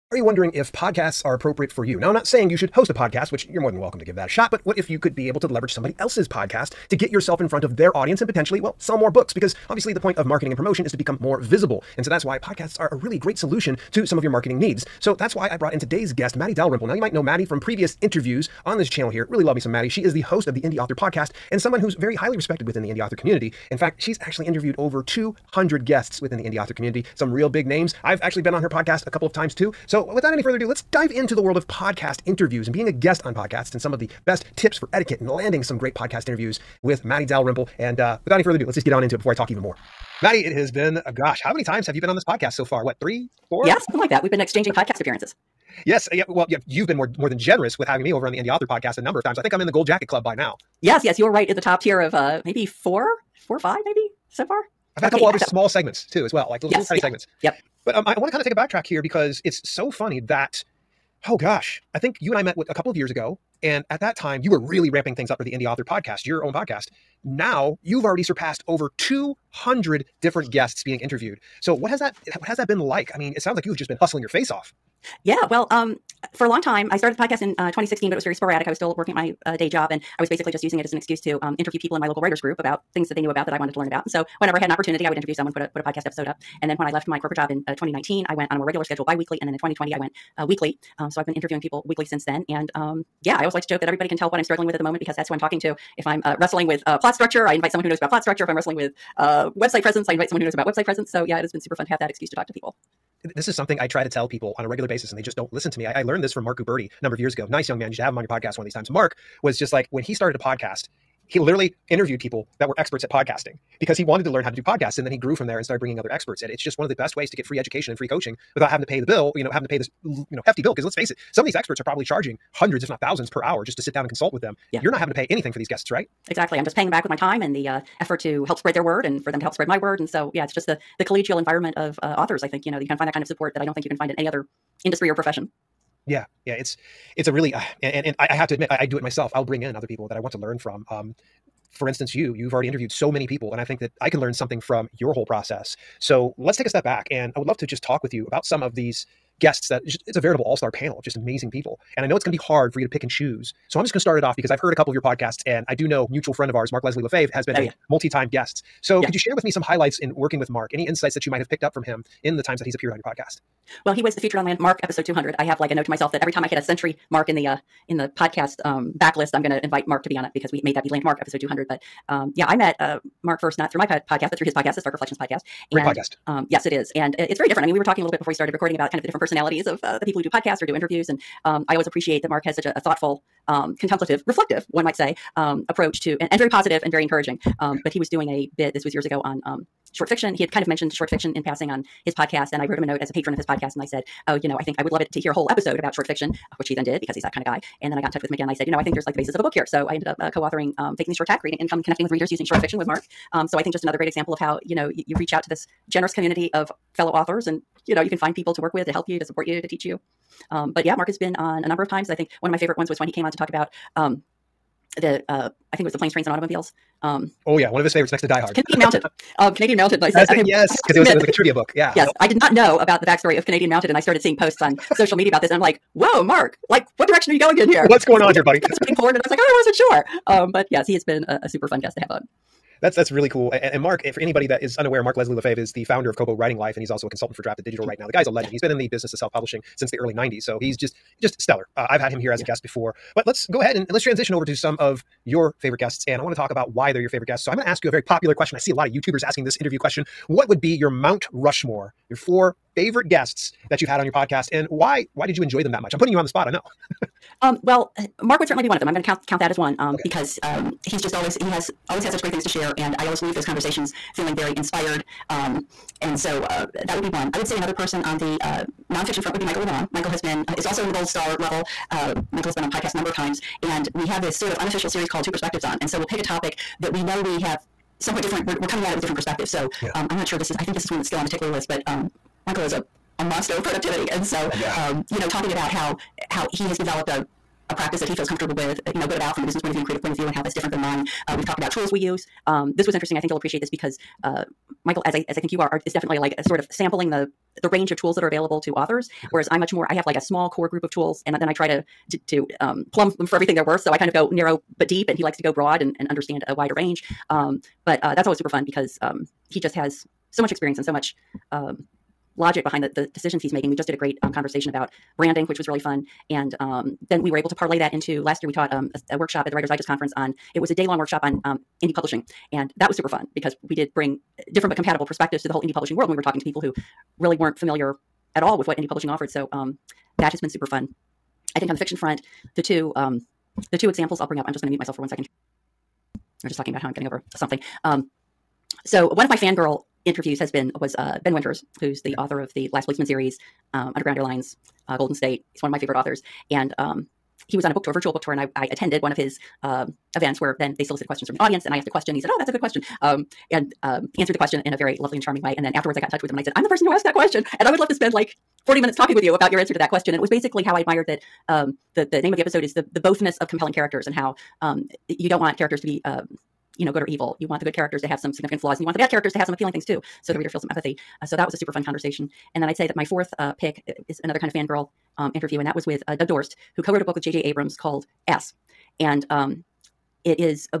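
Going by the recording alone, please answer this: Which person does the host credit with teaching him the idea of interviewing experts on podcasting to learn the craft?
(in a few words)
Mark Guberti.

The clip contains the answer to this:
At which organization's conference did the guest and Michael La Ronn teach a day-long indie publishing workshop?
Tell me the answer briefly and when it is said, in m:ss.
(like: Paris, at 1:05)
Writers Digest, at 5:19.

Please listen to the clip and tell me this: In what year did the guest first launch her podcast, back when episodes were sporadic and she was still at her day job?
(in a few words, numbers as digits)
2016.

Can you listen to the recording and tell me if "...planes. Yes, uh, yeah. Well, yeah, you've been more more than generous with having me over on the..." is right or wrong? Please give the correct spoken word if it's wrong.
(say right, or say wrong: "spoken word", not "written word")
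wrong: "appearances", not "planes".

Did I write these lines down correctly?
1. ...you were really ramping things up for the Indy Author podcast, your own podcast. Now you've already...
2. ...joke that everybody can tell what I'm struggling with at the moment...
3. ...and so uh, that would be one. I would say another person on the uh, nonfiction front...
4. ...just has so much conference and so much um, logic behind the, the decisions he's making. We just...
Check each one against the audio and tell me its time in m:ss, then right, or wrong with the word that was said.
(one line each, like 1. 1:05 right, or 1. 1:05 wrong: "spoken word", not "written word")
1. 1:04 right
2. 1:33 right
3. 4:26 right
4. 5:09 wrong: "experience", not "conference".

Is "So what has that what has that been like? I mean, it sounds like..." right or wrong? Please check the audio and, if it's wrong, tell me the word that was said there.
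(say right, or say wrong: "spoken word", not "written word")
right.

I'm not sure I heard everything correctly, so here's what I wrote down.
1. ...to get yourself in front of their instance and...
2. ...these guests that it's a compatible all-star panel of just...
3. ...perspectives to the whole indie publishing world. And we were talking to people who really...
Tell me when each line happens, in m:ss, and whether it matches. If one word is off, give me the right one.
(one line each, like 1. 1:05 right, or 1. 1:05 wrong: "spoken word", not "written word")
1. 0:06 wrong: "audience", not "instance"
2. 2:28 wrong: "veritable", not "compatible"
3. 5:25 right.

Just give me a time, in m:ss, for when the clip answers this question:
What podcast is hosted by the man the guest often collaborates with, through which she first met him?
2:54.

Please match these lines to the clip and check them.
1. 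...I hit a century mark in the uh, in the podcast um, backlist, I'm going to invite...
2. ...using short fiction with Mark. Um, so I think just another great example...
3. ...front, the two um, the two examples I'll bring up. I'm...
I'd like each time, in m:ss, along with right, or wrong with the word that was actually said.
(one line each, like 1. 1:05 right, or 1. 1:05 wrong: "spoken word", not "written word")
1. 2:46 right
2. 3:22 right
3. 5:31 right.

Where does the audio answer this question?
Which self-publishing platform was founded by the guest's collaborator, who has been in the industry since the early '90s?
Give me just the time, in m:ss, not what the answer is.
3:56.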